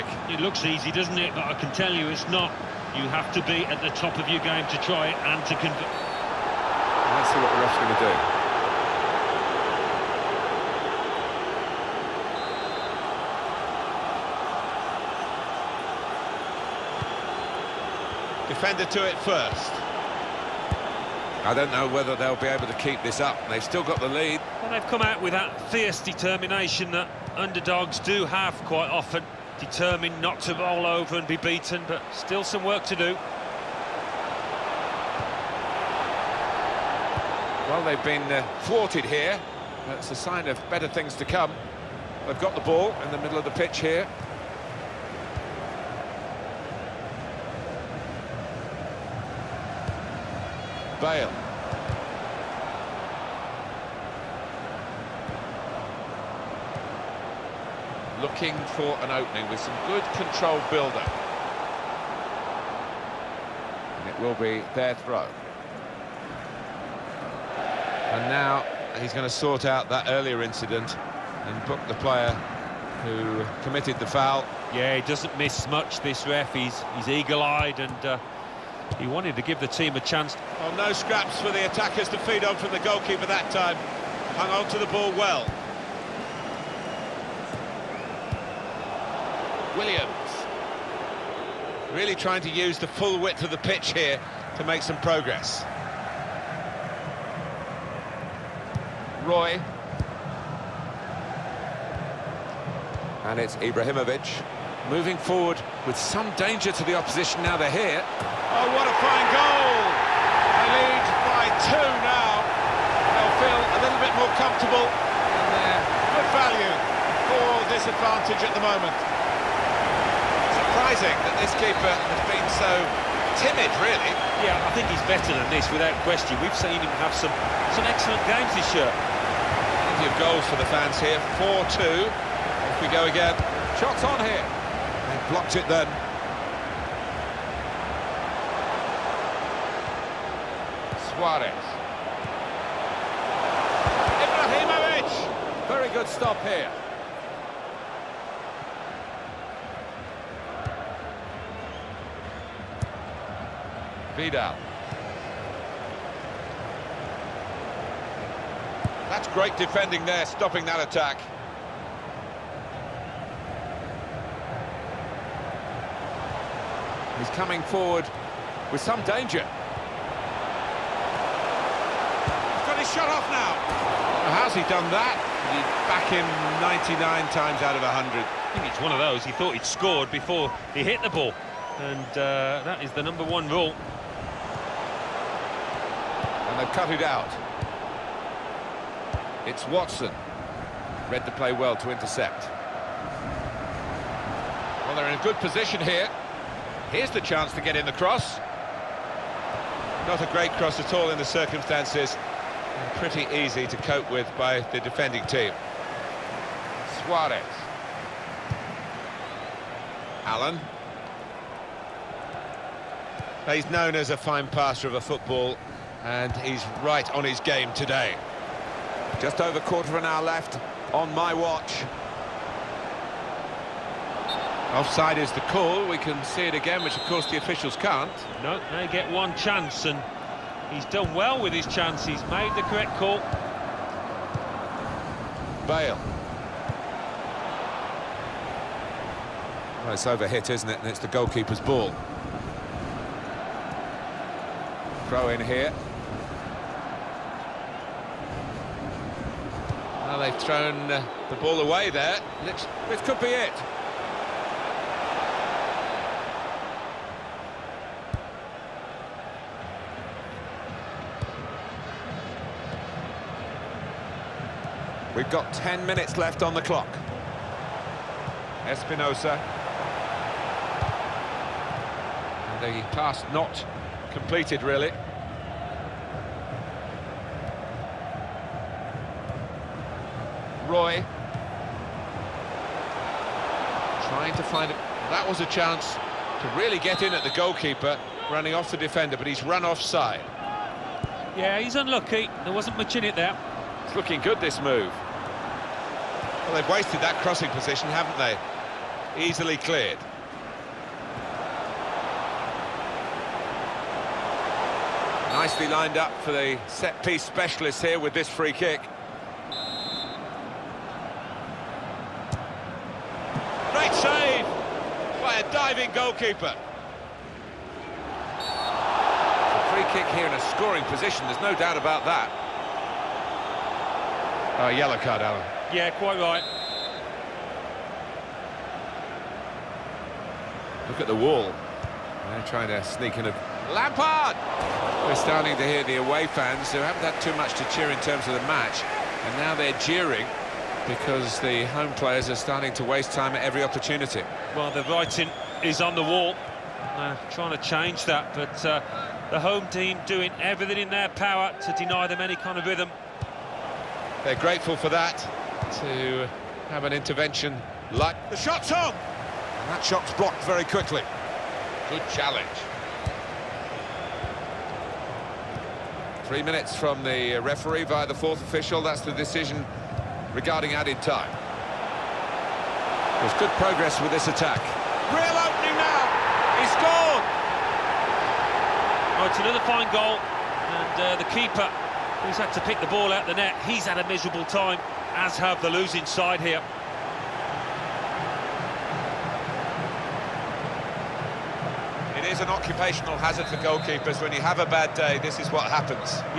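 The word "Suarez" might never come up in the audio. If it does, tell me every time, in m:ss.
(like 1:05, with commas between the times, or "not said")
2:21, 3:27.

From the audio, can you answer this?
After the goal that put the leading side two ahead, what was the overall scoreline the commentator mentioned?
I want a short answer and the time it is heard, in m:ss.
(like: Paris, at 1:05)
4-2, at 2:11.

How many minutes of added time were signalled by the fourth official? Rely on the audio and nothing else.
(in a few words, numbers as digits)
3.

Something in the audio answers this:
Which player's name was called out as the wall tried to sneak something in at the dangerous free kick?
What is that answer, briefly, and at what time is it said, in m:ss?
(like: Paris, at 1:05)
Lampard, at 5:33.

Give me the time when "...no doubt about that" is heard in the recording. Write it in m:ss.
5:21.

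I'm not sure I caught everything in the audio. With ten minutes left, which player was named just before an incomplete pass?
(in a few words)
Espinosa.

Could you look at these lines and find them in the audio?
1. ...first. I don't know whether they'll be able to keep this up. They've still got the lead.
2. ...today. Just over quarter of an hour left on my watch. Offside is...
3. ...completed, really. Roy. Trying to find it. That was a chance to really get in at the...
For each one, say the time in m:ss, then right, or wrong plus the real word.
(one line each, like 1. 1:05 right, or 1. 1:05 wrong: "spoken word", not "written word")
1. 0:19 right
2. 3:37 right
3. 4:34 right.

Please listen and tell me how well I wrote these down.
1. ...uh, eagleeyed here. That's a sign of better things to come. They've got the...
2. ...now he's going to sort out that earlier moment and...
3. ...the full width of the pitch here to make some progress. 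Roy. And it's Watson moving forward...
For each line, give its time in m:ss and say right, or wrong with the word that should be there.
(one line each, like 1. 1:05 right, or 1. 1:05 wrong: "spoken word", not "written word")
1. 0:38 wrong: "thwarted", not "eagleeyed"
2. 1:08 wrong: "incident", not "moment"
3. 1:32 wrong: "Ibrahimovic", not "Watson".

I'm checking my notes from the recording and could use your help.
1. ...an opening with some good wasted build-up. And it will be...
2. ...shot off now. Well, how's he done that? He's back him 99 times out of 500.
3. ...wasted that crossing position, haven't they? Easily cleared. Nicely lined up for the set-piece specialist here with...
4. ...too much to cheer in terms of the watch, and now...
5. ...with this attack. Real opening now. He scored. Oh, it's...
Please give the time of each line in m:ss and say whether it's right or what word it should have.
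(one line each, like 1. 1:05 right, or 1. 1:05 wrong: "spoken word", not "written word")
1. 0:59 wrong: "controlled", not "wasted"
2. 2:52 wrong: "100", not "500"
3. 4:56 right
4. 5:37 wrong: "match", not "watch"
5. 6:14 right.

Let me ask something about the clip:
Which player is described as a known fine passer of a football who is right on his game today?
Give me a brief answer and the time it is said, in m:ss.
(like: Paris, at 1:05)
Allen, at 3:30.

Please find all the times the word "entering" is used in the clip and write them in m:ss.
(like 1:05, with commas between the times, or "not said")
not said.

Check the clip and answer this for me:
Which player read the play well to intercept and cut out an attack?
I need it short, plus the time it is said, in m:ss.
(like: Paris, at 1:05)
Watson, at 3:09.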